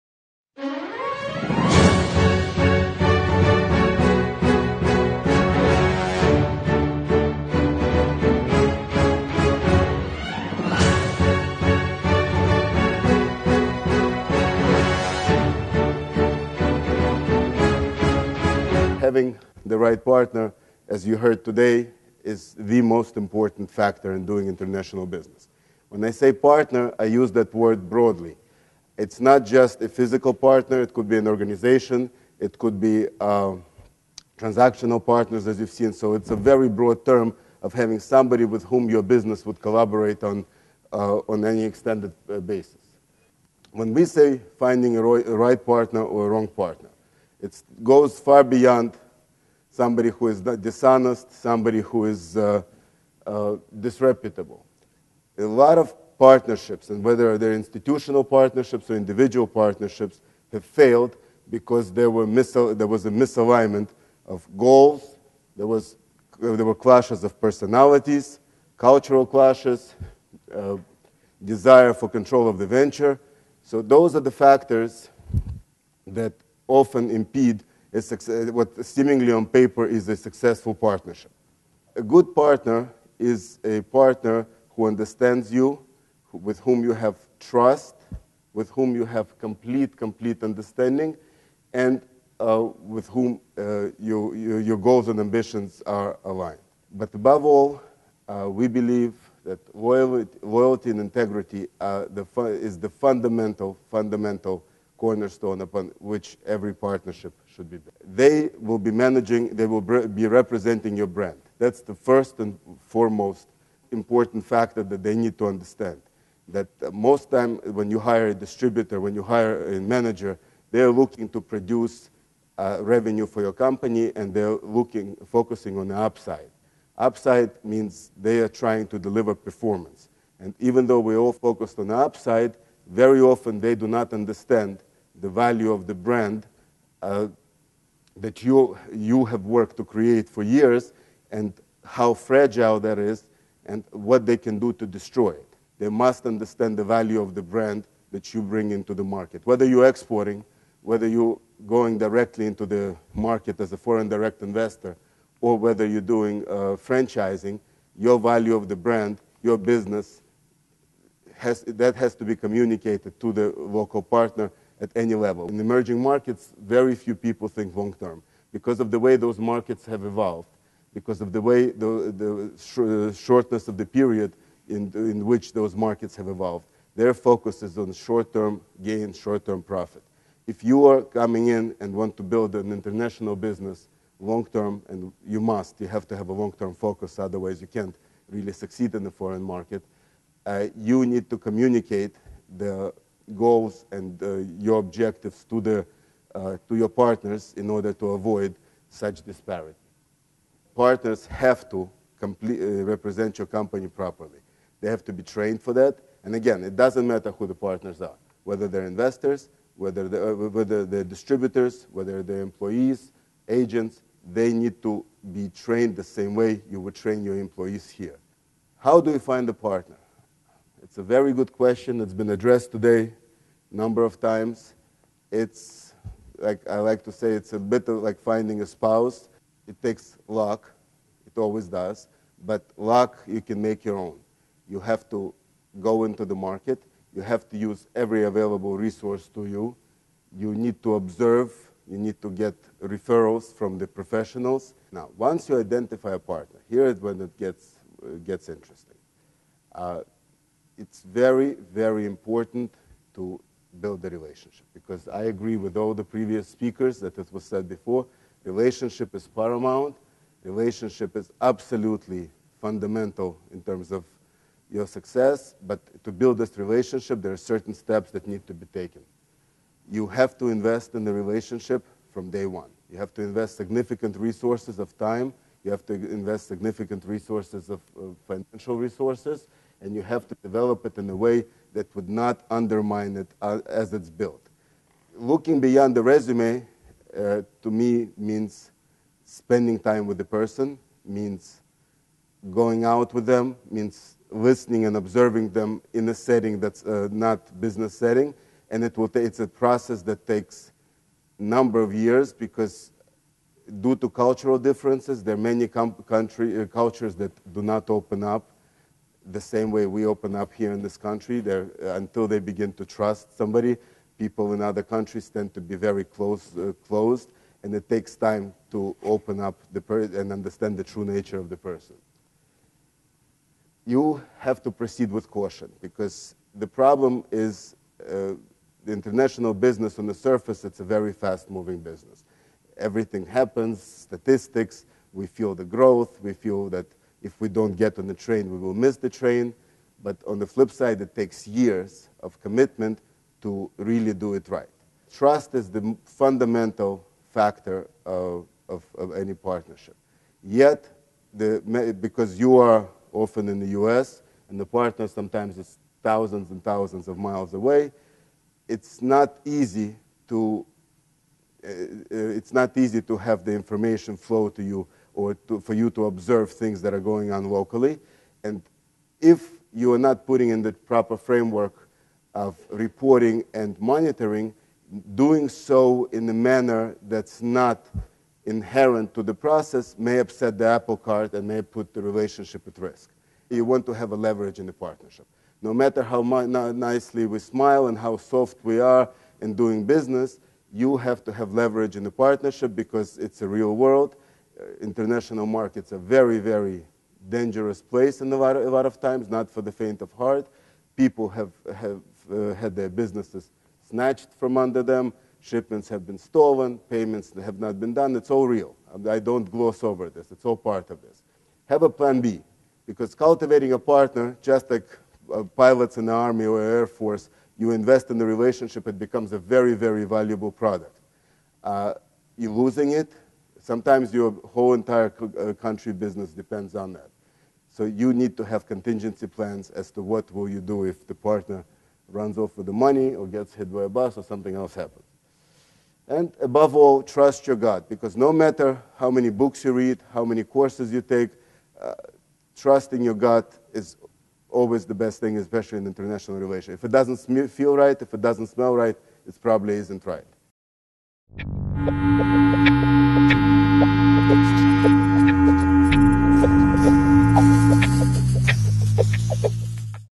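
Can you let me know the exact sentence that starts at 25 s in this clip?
When I say partner, I use that word broadly.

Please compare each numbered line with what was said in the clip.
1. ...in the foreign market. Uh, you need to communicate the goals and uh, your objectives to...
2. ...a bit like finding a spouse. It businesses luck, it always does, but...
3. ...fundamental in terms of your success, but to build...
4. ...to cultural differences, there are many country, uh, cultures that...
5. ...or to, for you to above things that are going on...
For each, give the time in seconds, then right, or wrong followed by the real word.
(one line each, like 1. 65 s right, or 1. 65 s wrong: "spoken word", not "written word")
1. 188 s right
2. 227 s wrong: "takes", not "businesses"
3. 262 s right
4. 303 s right
5. 365 s wrong: "observe", not "above".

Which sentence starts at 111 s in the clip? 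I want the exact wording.
That's the first and foremost important factor that they need to understand.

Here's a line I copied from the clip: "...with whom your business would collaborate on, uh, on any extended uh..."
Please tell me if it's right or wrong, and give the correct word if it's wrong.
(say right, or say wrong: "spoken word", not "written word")
right.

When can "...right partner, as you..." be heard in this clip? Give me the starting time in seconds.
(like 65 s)
19 s.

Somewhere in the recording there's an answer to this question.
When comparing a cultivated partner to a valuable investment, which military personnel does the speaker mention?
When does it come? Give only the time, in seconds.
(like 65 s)
415 s.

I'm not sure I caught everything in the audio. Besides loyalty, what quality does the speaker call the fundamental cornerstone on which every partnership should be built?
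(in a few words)
Integrity.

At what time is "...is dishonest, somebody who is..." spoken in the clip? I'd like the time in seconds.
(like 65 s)
50 s.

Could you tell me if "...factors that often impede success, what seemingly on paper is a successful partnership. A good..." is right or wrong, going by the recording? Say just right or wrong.
right.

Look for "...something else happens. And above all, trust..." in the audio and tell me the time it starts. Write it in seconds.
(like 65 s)
434 s.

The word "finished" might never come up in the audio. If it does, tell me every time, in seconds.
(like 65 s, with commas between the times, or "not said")
not said.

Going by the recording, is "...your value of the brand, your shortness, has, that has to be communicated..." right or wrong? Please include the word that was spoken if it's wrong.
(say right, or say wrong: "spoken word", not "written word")
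wrong: "business", not "shortness".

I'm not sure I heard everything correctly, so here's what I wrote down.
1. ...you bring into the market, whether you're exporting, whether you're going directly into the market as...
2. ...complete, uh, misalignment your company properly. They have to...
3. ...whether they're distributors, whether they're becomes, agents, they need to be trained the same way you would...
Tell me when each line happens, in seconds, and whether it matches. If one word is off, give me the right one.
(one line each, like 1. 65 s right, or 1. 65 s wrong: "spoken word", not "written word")
1. 148 s right
2. 202 s wrong: "represent", not "misalignment"
3. 210 s wrong: "employees", not "becomes".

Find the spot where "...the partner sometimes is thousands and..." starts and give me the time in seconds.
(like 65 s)
354 s.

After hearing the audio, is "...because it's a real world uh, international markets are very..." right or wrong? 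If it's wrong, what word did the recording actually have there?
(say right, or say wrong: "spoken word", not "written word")
right.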